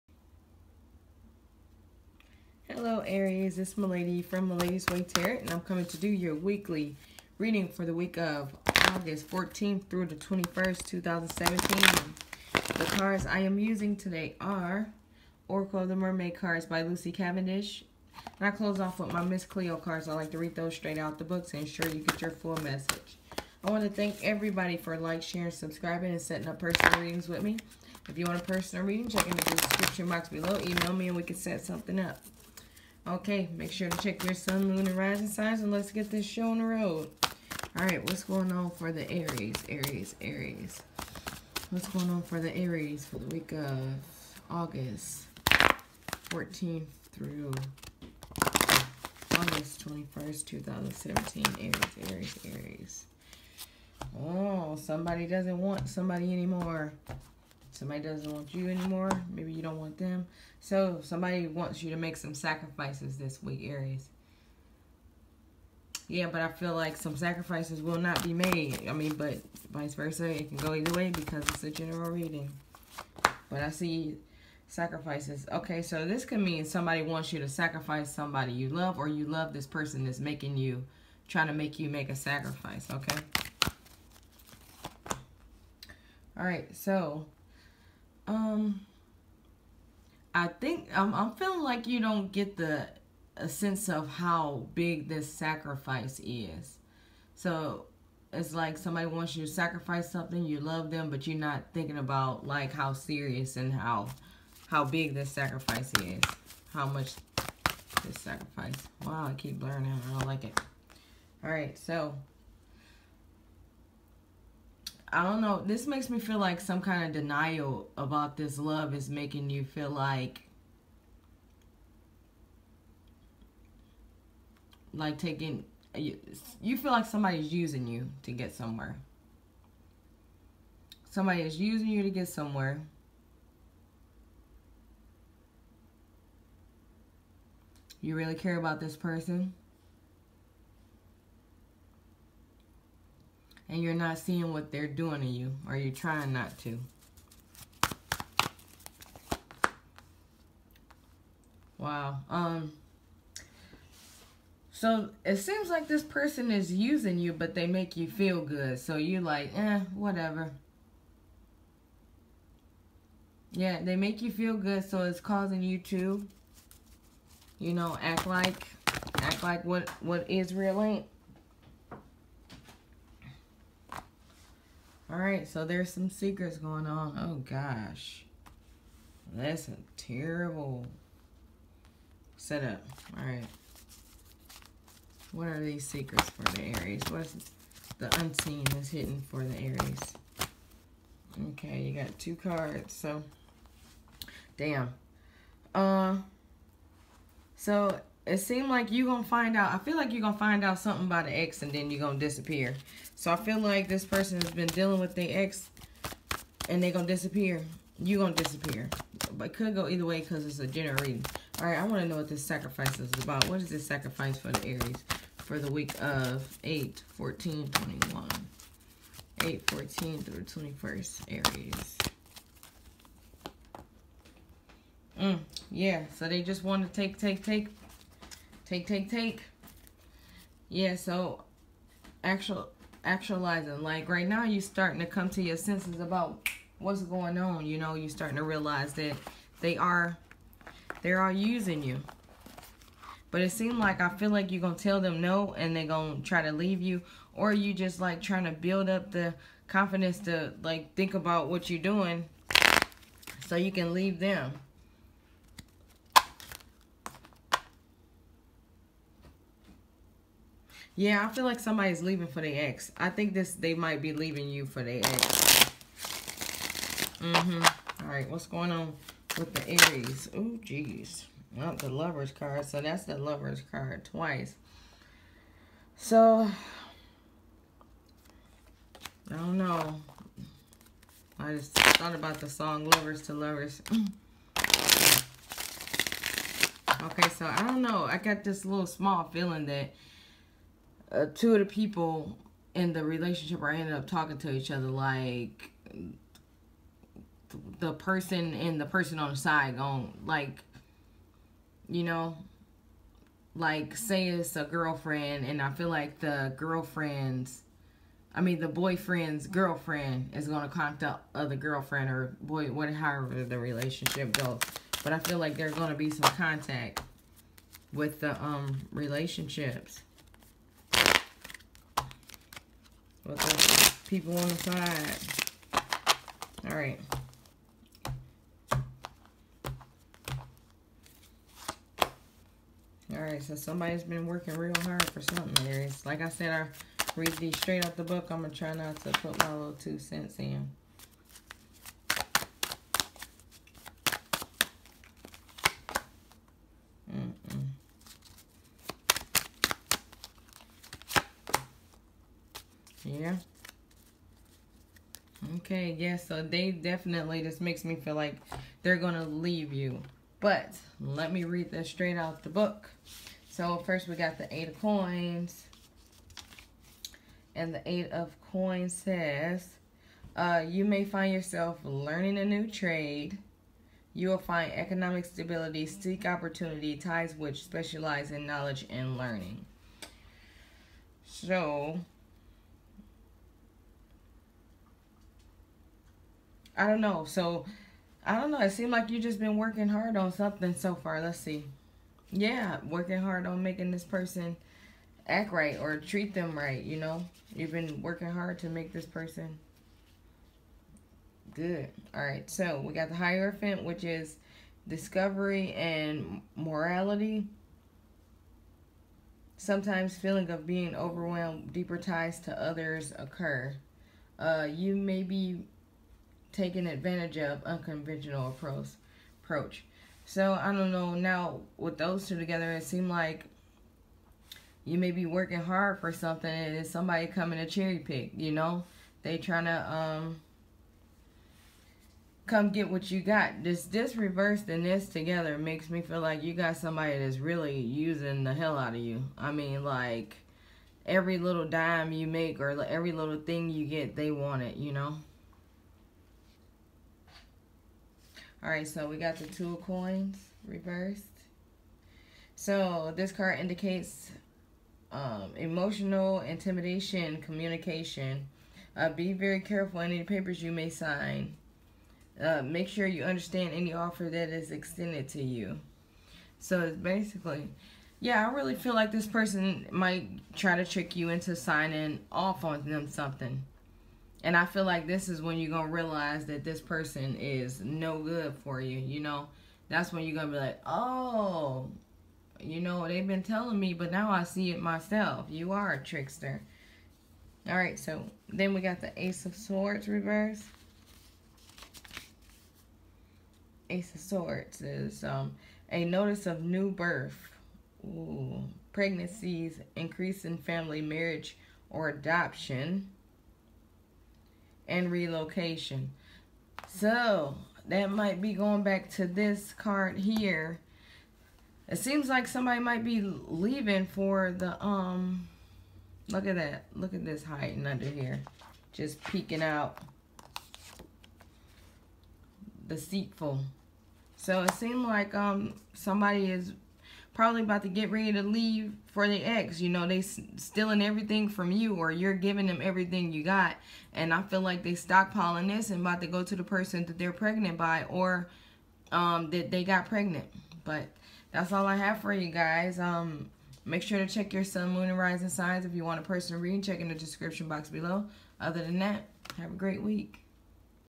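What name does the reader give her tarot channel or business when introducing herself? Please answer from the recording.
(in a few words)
Malady's Way Tarot.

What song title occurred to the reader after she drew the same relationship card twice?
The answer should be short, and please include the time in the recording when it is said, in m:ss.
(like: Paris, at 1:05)
Lovers to Lovers, at 4:42.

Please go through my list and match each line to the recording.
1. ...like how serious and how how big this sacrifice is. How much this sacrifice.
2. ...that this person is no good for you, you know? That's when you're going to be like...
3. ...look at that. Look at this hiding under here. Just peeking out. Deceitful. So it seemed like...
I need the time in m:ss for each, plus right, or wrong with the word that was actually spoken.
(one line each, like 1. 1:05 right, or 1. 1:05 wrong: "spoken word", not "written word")
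1. 1:42 right
2. 7:56 right
3. 8:36 right.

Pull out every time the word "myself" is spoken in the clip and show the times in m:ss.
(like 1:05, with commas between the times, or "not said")
8:04.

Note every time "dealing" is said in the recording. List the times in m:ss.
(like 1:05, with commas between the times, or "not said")
3:24.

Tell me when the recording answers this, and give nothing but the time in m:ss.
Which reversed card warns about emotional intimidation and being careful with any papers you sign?
7:29.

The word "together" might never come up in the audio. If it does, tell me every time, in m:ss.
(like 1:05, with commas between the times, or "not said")
7:02, 7:15.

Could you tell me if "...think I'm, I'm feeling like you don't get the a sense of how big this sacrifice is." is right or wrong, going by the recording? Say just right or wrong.
right.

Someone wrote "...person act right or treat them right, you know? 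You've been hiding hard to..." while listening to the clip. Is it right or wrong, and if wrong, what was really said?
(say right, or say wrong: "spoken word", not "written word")
wrong: "working", not "hiding".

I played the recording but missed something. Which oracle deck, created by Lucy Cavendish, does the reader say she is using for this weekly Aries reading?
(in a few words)
Oracle of the Mermaid.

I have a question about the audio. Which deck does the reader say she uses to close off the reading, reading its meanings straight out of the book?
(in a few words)
Miss Cleo cards.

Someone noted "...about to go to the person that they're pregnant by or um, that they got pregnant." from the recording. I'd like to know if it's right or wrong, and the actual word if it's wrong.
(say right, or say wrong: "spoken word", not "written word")
right.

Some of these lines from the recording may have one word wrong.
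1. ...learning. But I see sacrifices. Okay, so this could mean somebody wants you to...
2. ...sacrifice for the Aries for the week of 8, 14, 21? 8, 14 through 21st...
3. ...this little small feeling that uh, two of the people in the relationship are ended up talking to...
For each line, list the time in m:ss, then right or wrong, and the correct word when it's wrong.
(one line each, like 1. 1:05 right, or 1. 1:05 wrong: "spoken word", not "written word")
1. 1:12 wrong: "reading", not "learning"
2. 3:33 right
3. 4:48 right.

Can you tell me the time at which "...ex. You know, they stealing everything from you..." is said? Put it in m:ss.
8:49.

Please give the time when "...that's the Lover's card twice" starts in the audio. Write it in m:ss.
4:32.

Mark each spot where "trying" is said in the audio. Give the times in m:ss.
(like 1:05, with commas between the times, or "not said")
1:21, 2:25, 4:08, 7:09.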